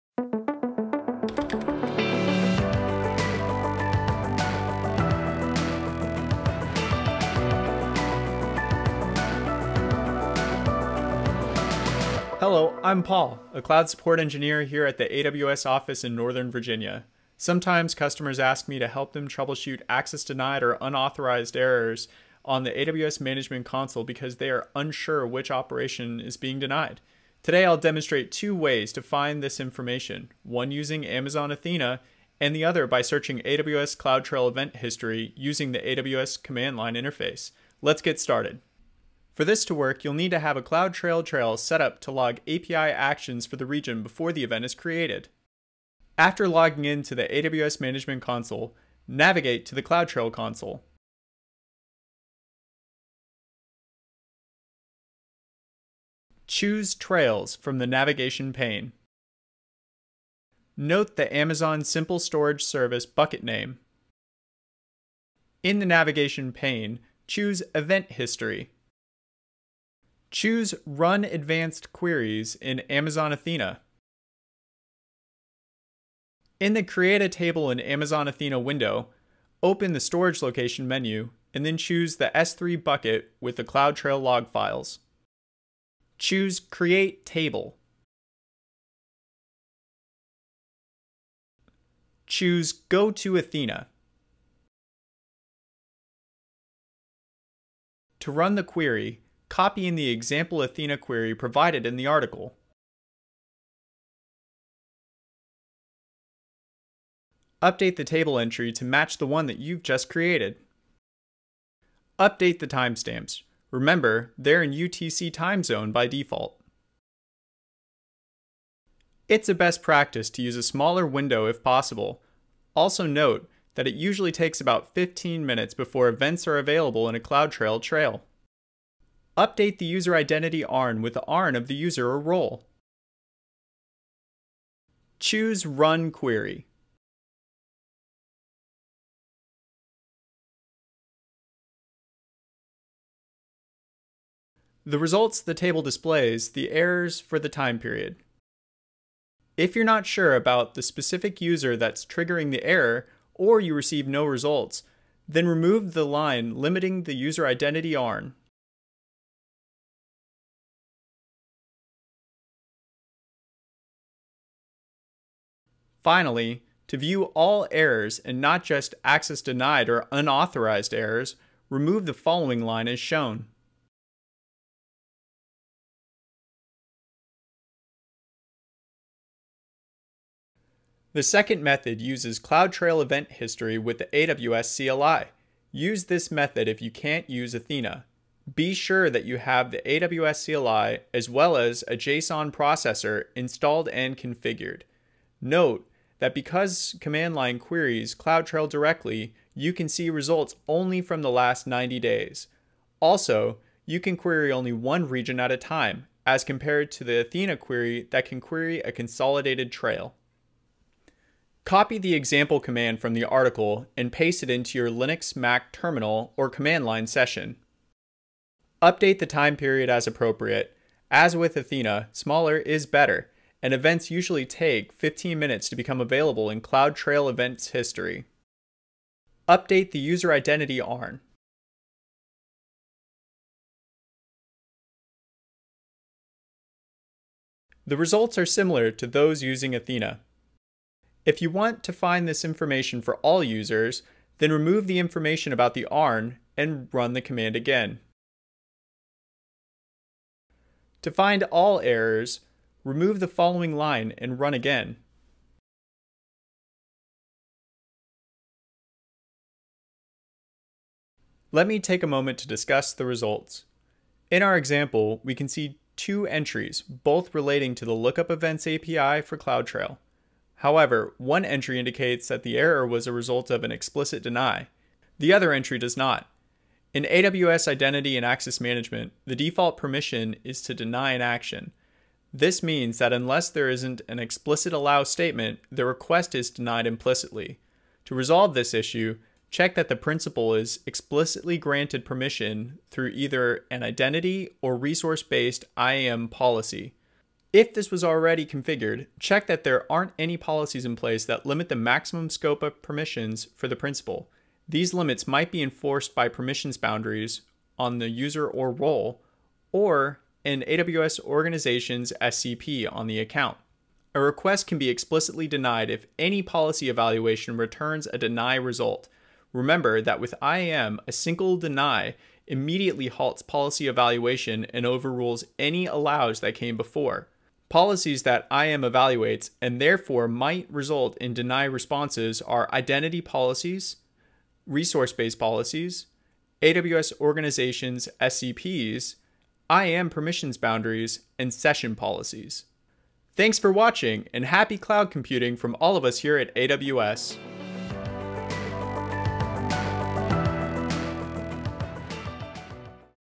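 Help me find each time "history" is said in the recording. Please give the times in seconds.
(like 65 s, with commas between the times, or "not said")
34 s, 68 s, 183 s, 227 s.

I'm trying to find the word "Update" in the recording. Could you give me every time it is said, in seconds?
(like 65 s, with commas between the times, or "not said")
107 s, 112 s, 129 s, 218 s, 229 s.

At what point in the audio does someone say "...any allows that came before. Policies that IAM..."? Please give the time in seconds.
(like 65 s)
325 s.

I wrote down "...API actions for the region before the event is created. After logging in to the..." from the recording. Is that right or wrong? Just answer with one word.
right.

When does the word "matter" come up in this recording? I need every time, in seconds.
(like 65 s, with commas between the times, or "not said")
not said.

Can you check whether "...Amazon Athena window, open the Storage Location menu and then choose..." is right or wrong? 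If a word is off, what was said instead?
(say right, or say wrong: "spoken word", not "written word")
right.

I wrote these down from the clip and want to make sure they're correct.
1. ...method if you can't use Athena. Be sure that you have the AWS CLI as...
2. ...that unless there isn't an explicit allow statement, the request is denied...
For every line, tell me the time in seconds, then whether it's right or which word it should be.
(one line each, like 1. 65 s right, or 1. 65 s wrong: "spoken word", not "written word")
1. 186 s right
2. 282 s right.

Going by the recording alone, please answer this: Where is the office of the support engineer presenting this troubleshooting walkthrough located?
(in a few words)
Northern Virginia.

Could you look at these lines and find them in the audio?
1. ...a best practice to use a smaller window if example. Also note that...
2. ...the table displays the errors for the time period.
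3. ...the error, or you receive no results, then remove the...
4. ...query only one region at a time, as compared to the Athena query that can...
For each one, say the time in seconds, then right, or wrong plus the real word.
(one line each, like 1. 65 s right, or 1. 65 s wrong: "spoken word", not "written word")
1. 119 s wrong: "possible", not "example"
2. 145 s right
3. 152 s right
4. 204 s right.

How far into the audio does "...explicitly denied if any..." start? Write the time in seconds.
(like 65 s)
314 s.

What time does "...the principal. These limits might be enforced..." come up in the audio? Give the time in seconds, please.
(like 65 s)
303 s.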